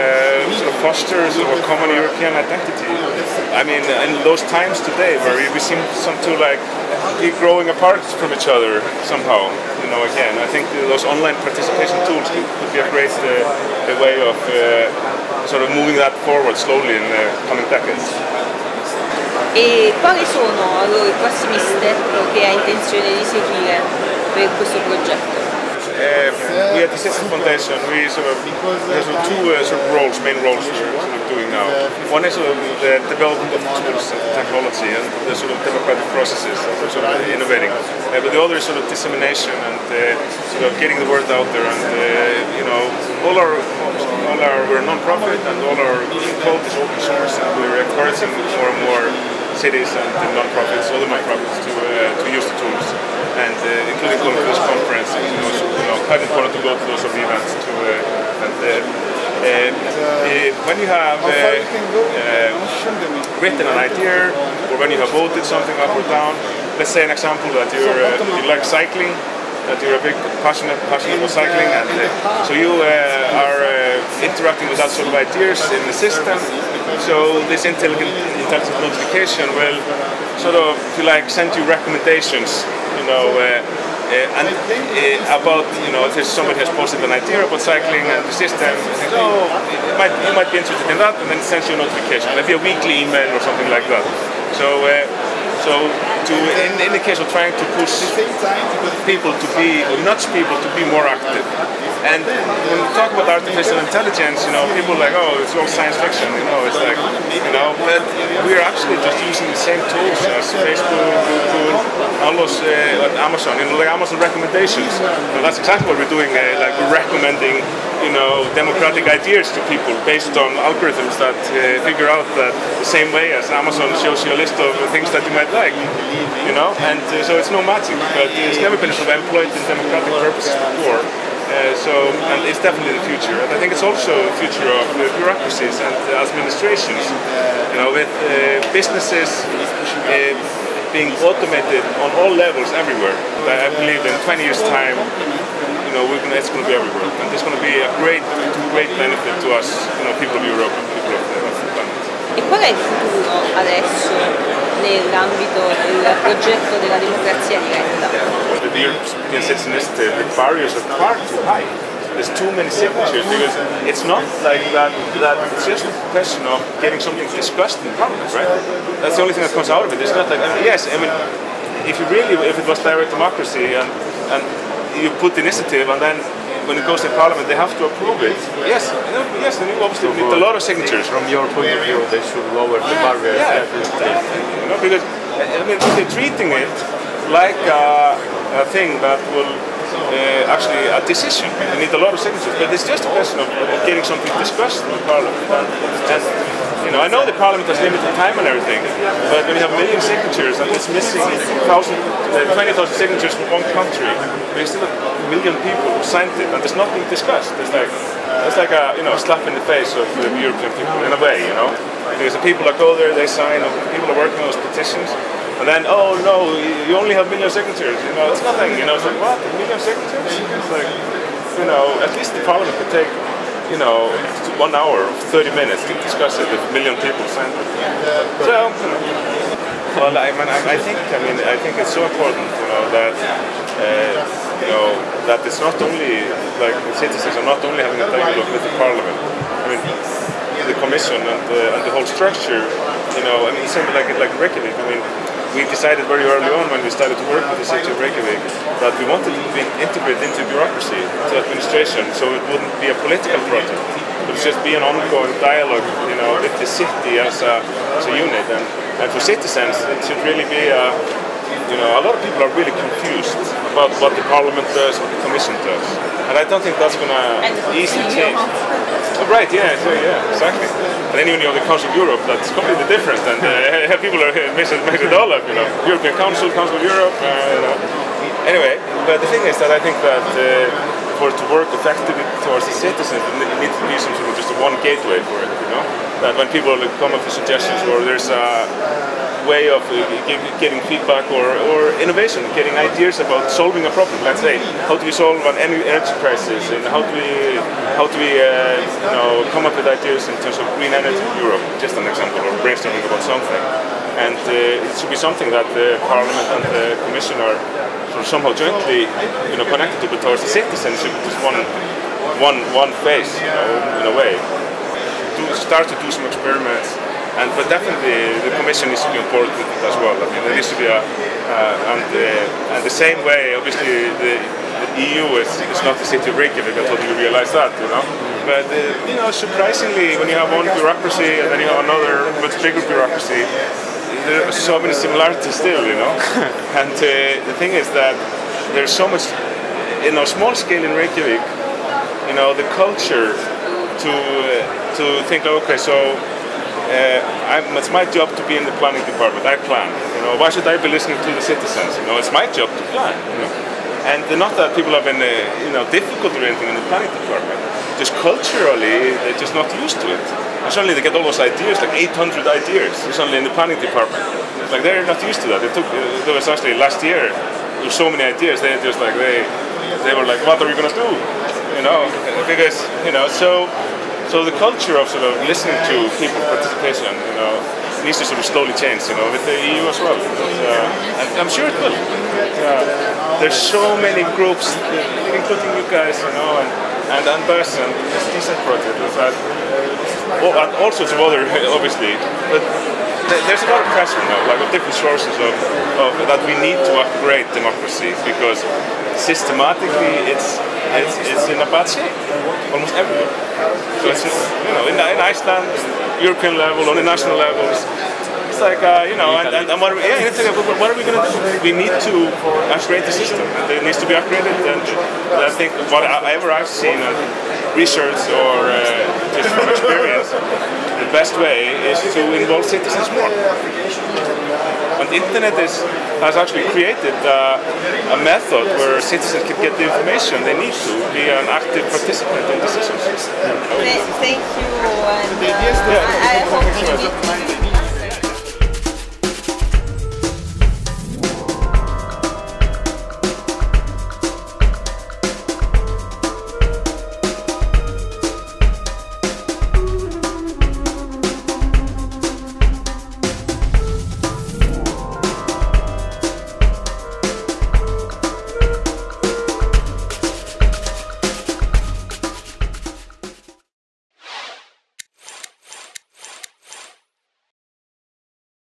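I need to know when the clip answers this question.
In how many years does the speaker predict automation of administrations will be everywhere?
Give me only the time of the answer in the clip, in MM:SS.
02:24.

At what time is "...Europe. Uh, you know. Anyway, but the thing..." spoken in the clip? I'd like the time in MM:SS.
04:36.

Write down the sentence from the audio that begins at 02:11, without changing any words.
Uh, so, and it's definitely the future.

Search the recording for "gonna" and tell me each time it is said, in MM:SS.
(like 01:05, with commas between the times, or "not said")
02:26, 06:10.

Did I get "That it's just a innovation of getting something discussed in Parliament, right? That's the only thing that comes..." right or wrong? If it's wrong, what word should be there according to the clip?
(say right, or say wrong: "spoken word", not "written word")
wrong: "question", not "innovation".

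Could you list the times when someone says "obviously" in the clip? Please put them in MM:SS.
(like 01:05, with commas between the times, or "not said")
02:59, 05:23, 06:31.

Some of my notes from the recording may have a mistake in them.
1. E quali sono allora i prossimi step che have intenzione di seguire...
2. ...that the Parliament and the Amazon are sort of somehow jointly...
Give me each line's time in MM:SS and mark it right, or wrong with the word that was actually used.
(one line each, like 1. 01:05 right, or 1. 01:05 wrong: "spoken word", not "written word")
1. 00:19 right
2. 05:05 wrong: "Commission", not "Amazon".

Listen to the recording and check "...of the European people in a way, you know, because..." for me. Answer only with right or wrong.
right.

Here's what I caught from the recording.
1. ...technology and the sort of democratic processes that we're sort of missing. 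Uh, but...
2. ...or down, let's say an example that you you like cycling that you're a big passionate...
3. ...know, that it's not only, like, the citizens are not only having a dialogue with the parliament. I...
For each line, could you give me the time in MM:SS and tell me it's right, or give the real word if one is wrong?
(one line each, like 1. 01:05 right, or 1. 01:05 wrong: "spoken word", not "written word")
1. 00:34 wrong: "innovating", not "missing"
2. 01:05 right
3. 03:54 right.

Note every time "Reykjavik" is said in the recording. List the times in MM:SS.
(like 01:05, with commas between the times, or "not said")
04:07, 05:26, 05:40.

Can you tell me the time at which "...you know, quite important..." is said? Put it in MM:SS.
00:55.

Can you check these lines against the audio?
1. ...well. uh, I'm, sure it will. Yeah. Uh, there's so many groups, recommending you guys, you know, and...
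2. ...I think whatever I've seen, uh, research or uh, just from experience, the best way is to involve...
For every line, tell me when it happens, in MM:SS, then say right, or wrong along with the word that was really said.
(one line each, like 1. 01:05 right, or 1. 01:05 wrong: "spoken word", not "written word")
1. 06:20 wrong: "including", not "recommending"
2. 06:55 right.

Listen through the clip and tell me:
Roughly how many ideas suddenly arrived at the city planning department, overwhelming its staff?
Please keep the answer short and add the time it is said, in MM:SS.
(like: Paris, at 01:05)
800, at 06:01.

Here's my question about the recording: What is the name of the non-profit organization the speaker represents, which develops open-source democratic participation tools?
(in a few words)
Citizen Foundation.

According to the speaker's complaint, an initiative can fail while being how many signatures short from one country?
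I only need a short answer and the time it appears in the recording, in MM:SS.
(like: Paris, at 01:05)
20,000, at 03:21.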